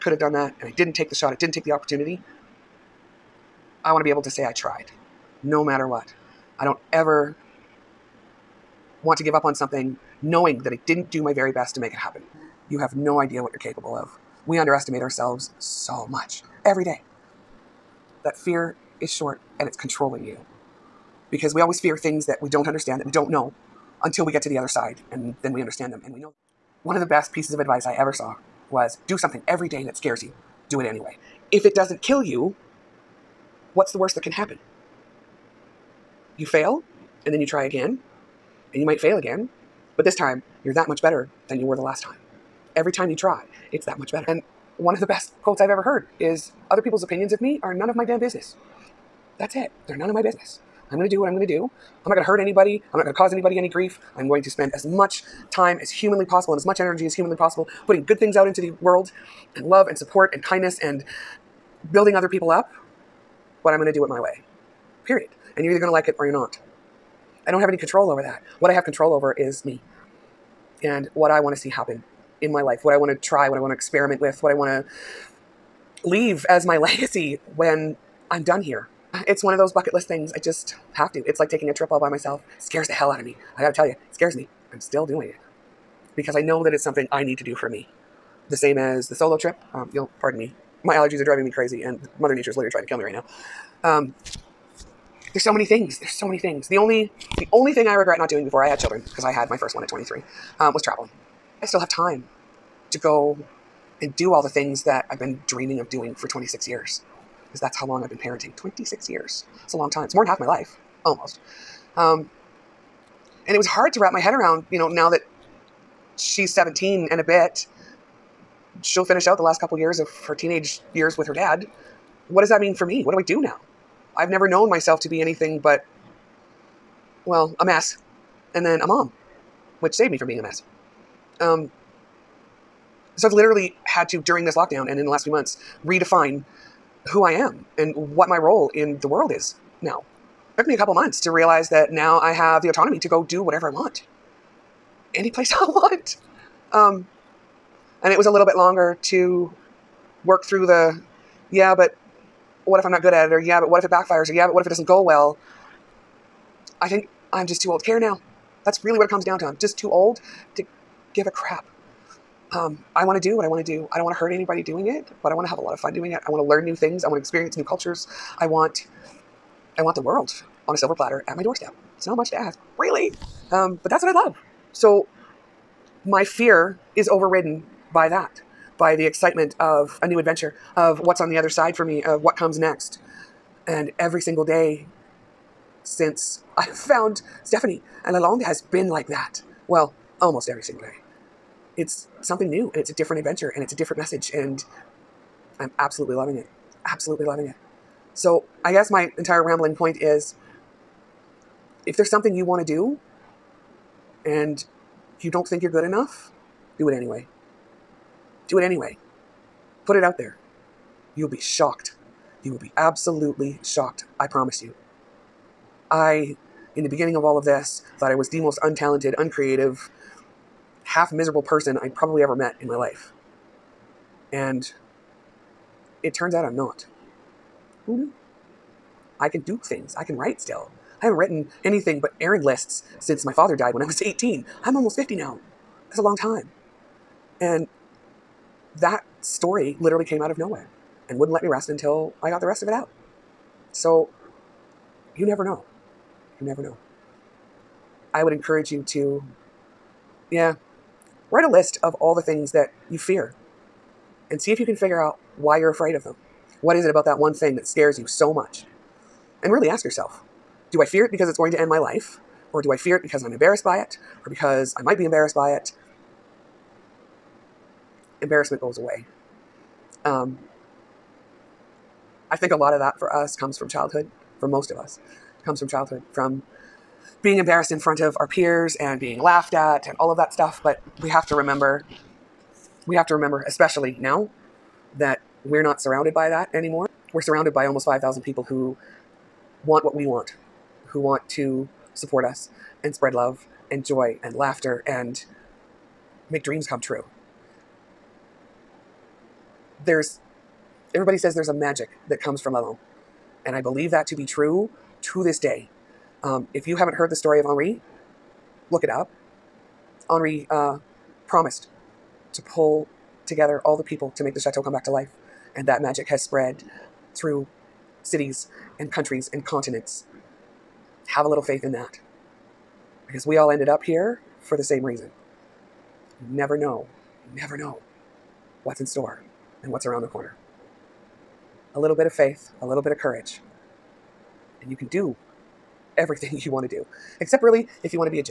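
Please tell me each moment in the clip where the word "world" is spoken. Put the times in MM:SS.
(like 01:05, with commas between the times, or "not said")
00:58, 02:19, 02:49.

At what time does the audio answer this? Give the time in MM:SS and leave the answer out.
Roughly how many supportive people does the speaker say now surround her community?
04:47.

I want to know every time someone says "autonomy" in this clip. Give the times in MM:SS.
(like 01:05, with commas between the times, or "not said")
02:22.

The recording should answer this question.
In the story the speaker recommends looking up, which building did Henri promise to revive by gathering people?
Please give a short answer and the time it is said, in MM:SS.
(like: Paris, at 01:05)
The chateau, at 05:14.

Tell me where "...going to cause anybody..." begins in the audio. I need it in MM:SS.
00:53.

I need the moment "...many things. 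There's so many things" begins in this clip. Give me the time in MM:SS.
01:35.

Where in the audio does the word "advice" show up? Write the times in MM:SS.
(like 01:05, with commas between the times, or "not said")
00:27.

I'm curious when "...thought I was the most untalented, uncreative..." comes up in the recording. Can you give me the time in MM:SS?
03:37.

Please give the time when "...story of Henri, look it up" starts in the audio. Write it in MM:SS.
05:07.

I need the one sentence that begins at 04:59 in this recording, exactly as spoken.
There's everybody says there's a magic that comes from La Lande.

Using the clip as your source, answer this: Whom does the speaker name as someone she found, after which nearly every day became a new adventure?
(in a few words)
Stephanie.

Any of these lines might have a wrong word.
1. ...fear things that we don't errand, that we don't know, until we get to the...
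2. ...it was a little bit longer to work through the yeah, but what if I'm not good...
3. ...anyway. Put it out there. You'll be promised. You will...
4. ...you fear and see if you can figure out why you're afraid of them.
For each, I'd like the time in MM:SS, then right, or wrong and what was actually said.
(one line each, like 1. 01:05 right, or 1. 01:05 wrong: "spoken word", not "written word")
1. 00:21 wrong: "understand", not "errand"
2. 02:28 right
3. 03:28 wrong: "shocked", not "promised"
4. 04:12 right.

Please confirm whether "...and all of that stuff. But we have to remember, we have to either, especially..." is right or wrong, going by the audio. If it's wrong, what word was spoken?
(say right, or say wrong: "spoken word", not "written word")
wrong: "remember", not "either".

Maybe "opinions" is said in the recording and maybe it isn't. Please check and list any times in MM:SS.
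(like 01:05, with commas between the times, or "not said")
00:47.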